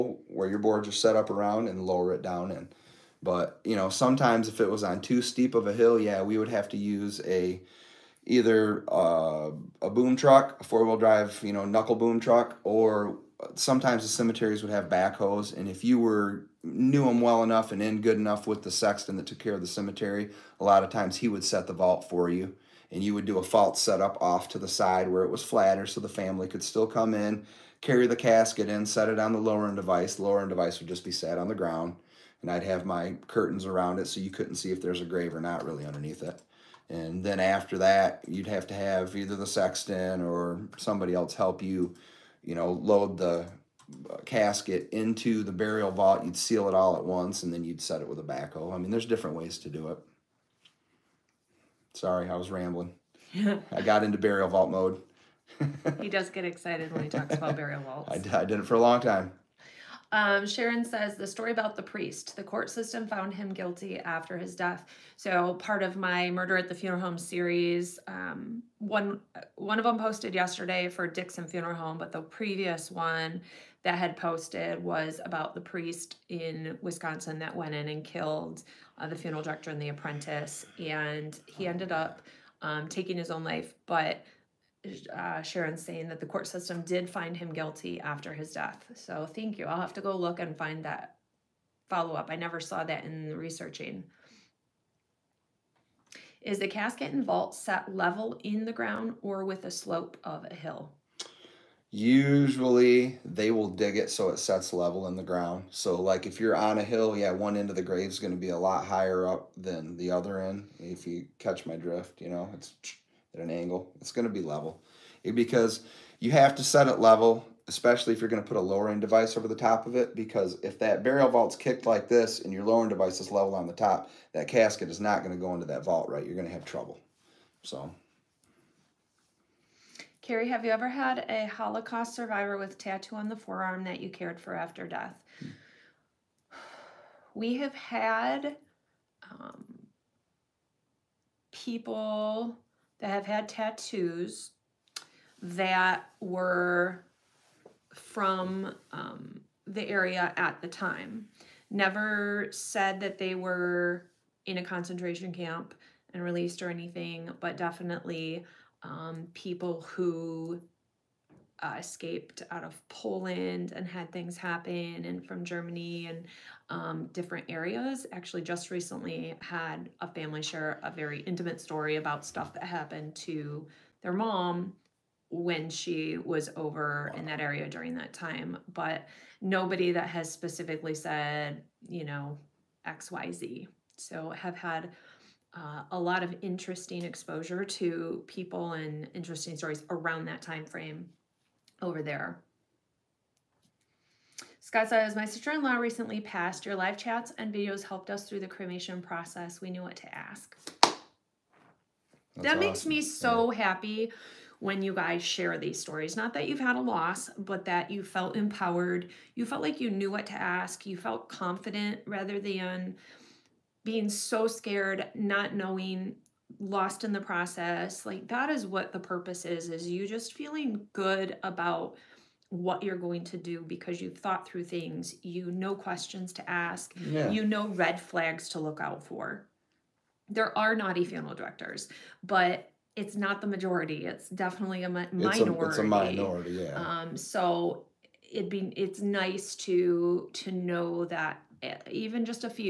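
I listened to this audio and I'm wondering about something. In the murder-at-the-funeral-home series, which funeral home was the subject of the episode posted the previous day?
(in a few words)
Dixon Funeral Home.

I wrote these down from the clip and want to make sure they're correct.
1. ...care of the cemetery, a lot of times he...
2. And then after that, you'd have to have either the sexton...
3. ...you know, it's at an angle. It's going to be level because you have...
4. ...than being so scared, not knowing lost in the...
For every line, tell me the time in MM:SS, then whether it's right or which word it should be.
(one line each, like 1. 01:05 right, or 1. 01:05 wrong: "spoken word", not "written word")
1. 00:19 right
2. 00:36 right
3. 01:52 right
4. 03:32 right.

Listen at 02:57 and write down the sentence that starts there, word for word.
in that area during that time.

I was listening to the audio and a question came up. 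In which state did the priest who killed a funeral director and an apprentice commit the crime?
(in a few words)
Wisconsin.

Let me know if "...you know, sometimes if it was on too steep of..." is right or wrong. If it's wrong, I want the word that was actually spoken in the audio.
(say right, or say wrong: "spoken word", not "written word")
right.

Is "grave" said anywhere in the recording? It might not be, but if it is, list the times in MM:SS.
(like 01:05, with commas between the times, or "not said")
00:35, 01:47.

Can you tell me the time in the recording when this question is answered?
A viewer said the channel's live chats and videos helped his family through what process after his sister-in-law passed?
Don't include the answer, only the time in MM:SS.
03:18.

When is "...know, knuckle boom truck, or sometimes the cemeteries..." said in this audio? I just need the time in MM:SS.
00:11.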